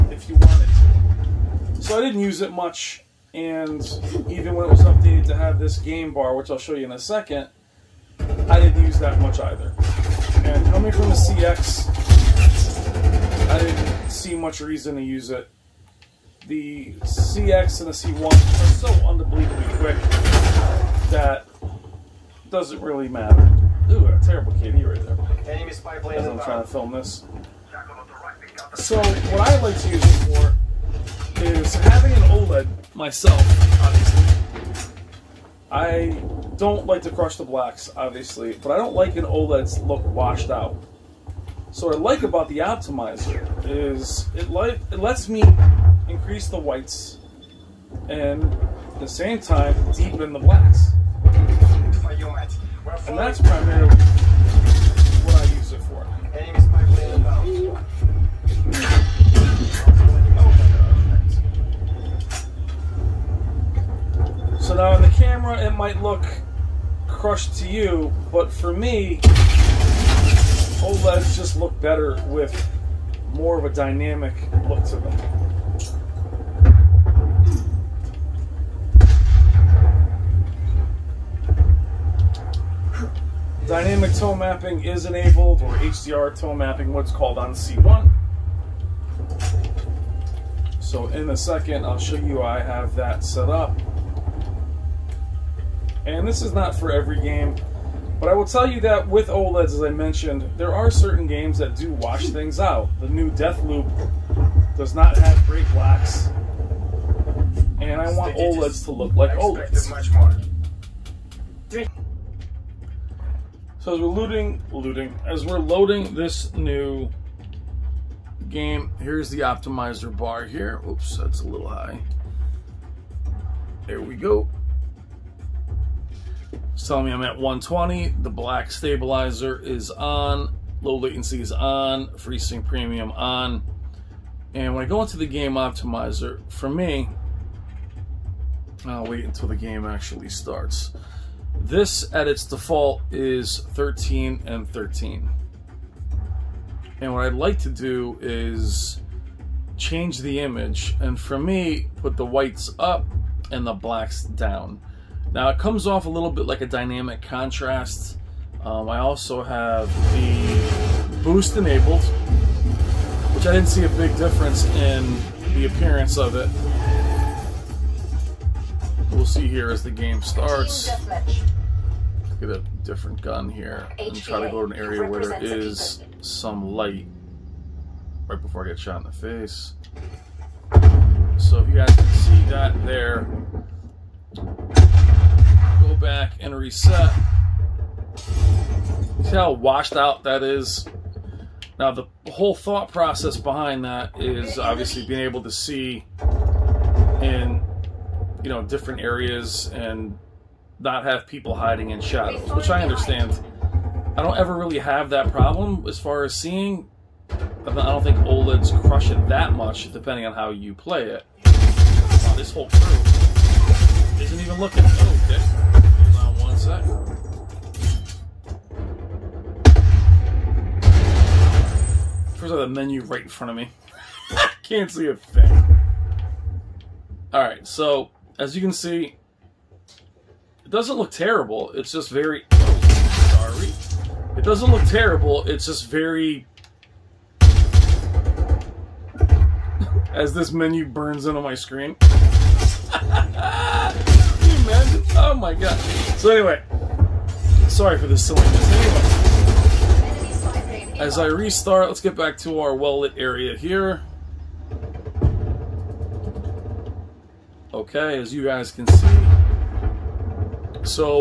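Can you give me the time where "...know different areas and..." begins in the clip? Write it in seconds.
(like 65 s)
198 s.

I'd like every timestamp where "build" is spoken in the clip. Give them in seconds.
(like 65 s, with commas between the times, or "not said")
not said.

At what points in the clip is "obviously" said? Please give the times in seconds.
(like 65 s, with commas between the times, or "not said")
33 s, 37 s, 194 s.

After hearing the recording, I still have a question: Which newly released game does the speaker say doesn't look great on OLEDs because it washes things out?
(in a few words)
Deathloop.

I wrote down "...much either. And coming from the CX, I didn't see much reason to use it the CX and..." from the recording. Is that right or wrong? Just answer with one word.
right.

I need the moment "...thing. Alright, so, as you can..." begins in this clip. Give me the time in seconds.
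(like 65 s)
225 s.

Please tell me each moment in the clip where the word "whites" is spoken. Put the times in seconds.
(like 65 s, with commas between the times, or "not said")
46 s, 152 s.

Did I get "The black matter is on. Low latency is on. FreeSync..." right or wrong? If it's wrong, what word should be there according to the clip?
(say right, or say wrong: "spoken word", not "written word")
wrong: "stabilizer", not "matter".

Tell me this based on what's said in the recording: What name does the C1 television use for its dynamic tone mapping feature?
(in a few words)
HDR tone mapping.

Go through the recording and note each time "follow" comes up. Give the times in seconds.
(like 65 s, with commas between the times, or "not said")
not said.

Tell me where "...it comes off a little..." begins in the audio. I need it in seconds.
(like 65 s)
155 s.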